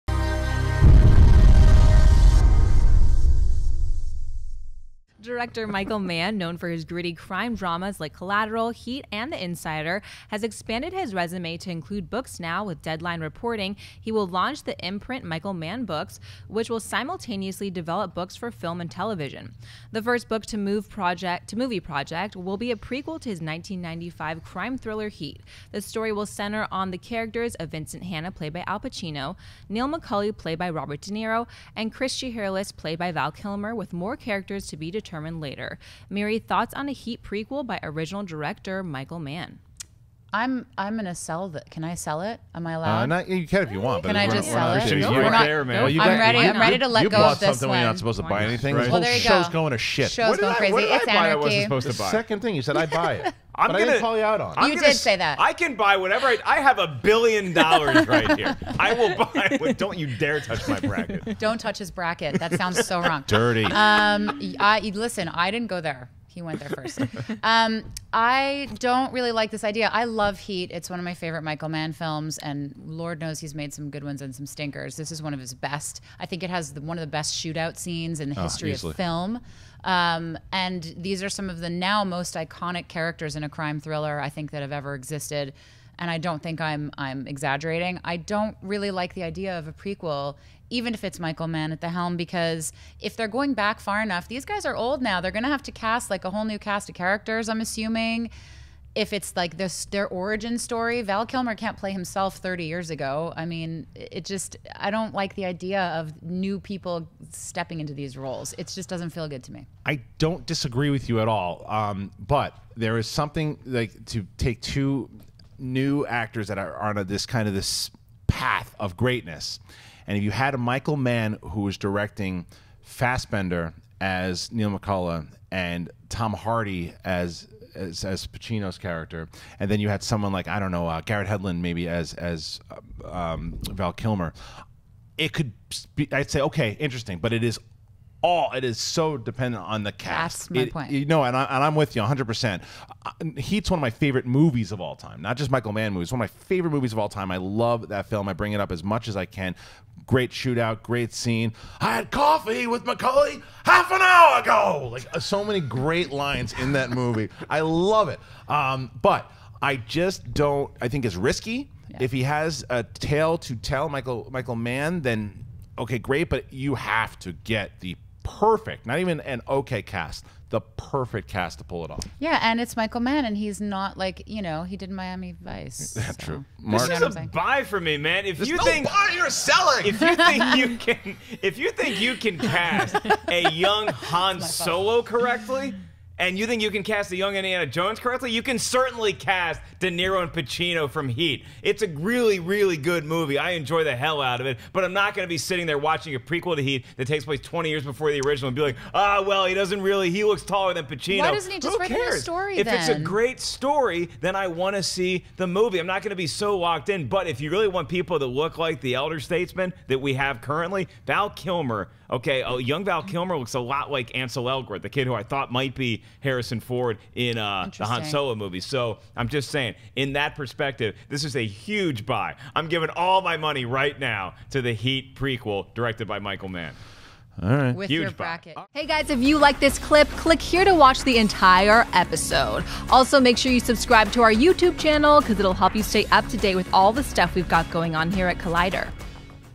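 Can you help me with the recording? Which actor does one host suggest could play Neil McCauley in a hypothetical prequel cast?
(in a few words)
Fassbender.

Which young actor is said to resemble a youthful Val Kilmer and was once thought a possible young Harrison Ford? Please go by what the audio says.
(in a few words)
Ansel Elgort.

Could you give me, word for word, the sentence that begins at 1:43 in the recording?
I mean, it just, I don't like the idea of new people stepping into these roles.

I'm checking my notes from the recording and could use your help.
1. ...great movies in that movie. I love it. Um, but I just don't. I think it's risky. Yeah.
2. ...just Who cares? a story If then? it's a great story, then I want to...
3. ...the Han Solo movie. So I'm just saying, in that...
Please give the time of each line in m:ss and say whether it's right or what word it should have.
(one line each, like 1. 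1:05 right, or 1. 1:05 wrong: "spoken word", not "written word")
1. 2:35 wrong: "lines", not "movies"
2. 3:21 right
3. 3:37 right.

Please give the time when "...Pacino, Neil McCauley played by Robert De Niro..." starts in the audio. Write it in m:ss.
0:28.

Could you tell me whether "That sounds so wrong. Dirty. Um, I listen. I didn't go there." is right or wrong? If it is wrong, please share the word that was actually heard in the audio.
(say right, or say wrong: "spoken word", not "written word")
right.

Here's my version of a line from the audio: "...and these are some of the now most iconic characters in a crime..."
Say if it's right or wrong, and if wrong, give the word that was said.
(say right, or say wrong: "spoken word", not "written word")
right.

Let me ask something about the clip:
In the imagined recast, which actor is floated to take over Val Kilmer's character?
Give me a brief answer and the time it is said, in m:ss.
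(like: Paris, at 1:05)
Garrett Hedlund, at 2:11.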